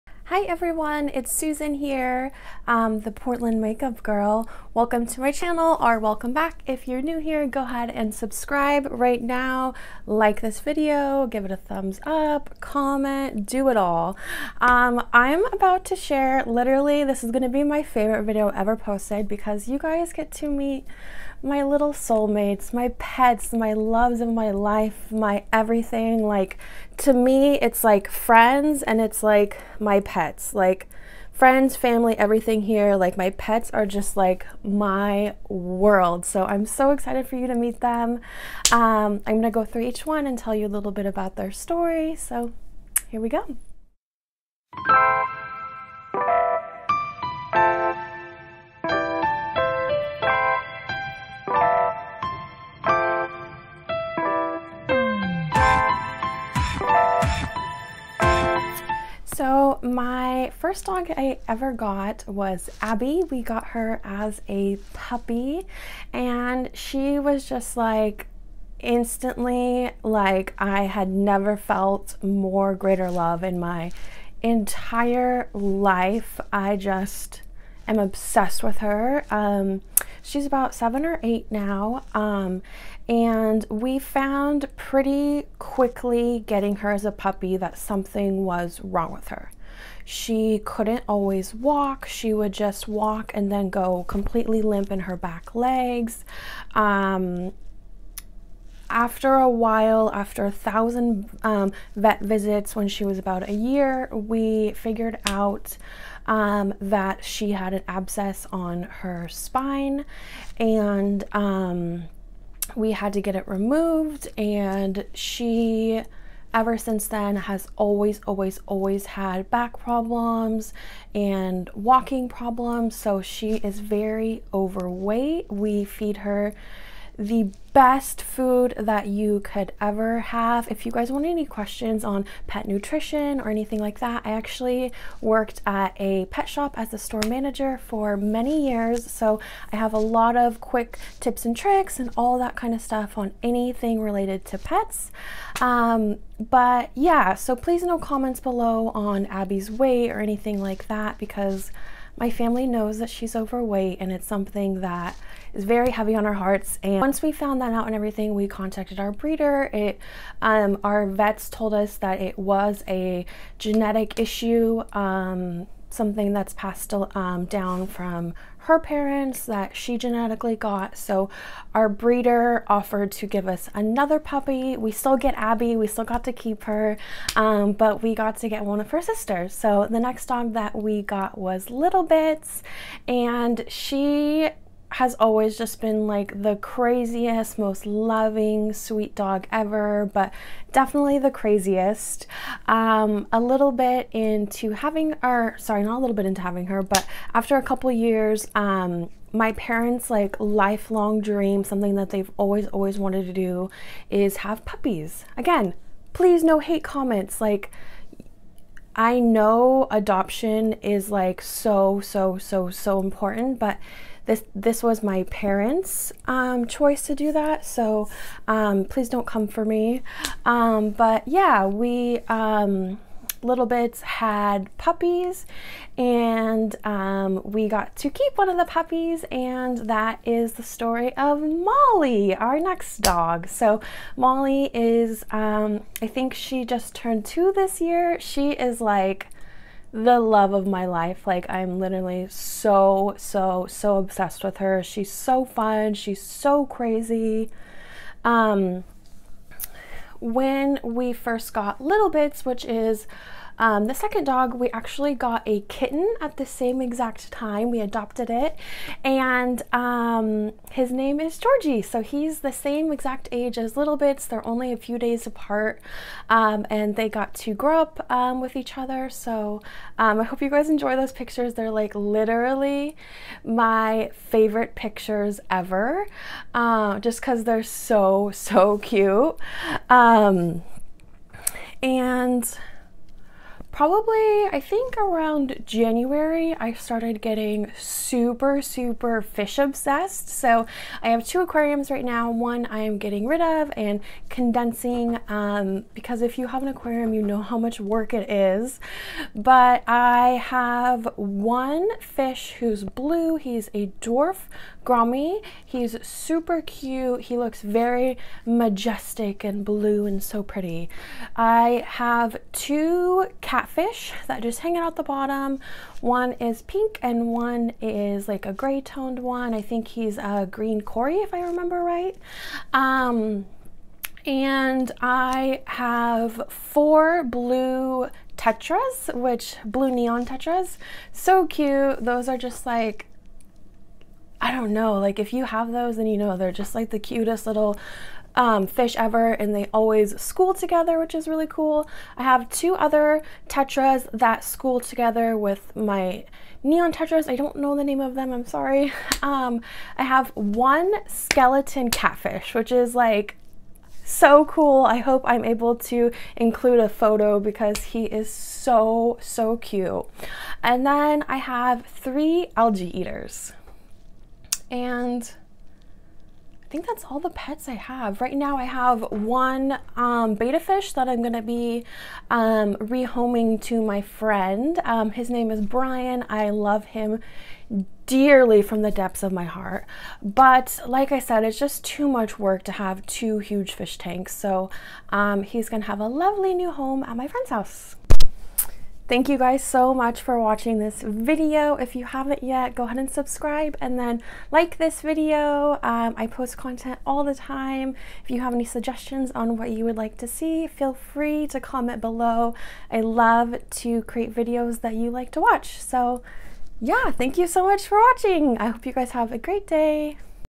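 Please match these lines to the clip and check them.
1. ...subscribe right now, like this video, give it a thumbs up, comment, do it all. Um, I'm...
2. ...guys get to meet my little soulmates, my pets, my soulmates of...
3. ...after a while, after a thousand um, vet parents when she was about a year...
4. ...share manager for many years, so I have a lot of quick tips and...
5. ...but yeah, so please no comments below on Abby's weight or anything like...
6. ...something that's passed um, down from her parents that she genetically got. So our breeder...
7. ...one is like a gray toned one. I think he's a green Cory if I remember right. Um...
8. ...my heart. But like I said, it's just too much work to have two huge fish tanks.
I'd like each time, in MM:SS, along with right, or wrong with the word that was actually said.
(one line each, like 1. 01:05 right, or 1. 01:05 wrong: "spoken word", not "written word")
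1. 00:08 right
2. 00:19 wrong: "loves", not "soulmates"
3. 01:38 wrong: "visits", not "parents"
4. 02:16 wrong: "store", not "share"
5. 02:26 right
6. 02:45 right
7. 05:17 right
8. 06:19 right.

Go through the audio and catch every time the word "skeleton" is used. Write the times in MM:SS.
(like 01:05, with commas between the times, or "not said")
05:51.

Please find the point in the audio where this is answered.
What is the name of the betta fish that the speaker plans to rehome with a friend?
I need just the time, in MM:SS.
06:15.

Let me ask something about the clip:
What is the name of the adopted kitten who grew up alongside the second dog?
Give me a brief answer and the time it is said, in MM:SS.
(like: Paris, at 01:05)
Georgie, at 04:21.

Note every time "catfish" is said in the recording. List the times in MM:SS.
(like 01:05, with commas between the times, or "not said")
05:13, 05:51.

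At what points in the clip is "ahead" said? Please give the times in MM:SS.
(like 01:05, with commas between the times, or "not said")
00:07, 06:32.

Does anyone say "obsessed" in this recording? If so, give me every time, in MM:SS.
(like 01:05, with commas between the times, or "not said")
01:17, 04:03, 04:49.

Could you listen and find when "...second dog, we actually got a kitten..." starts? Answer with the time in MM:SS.
04:13.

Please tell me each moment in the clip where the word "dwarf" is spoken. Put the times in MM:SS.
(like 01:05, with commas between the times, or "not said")
05:04.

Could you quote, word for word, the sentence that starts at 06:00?
And then I have three algae eaters and I think that's all the pets I have.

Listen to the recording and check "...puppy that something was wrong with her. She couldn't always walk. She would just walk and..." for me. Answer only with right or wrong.
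right.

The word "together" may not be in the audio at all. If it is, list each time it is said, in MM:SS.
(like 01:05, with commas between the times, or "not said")
05:40, 05:44.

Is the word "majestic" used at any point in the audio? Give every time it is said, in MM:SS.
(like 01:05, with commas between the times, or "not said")
05:08.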